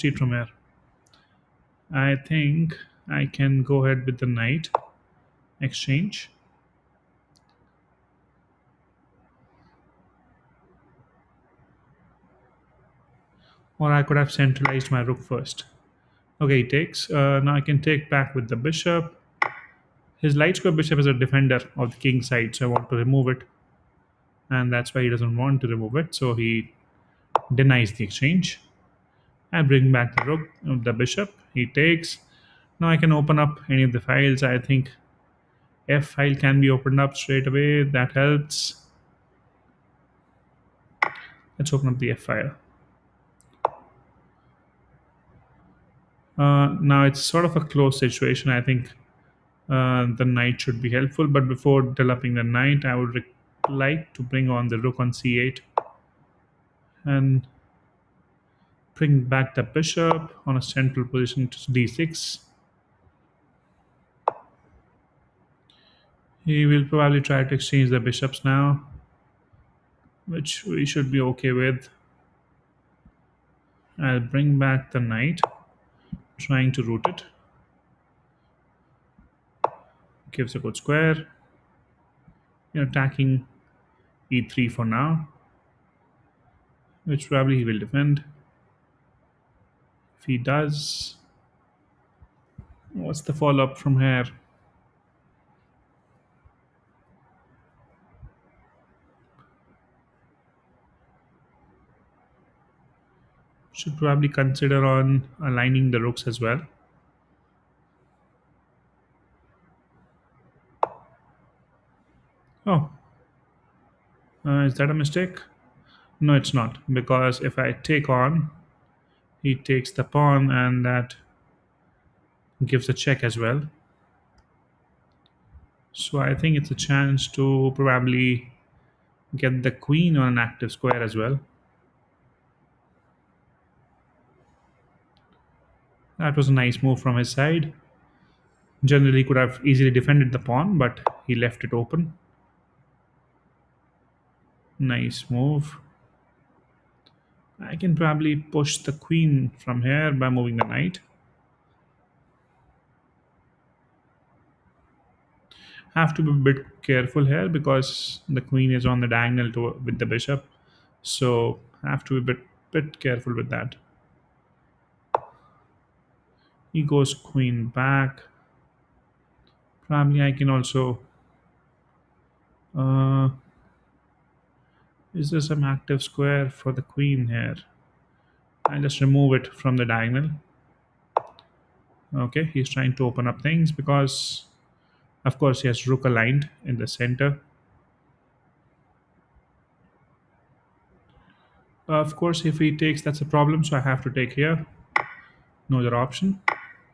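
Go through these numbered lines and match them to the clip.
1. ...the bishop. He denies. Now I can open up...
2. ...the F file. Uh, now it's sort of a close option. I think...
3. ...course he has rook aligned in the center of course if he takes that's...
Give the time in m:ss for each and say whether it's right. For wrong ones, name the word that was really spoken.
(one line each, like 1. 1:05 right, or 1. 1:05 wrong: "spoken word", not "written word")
1. 0:30 wrong: "takes", not "denies"
2. 0:41 wrong: "situation", not "option"
3. 3:05 right.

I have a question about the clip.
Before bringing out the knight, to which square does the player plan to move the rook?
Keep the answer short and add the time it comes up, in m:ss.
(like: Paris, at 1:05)
c8, at 0:55.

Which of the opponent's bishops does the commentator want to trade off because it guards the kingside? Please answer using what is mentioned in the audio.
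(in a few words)
light square bishop.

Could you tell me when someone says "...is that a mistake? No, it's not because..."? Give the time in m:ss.
1:54.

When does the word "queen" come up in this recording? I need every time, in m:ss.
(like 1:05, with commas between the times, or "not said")
2:09, 2:28, 2:38, 2:47, 2:56.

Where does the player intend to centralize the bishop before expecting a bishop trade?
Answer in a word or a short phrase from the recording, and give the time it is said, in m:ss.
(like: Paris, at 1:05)
d6, at 1:01.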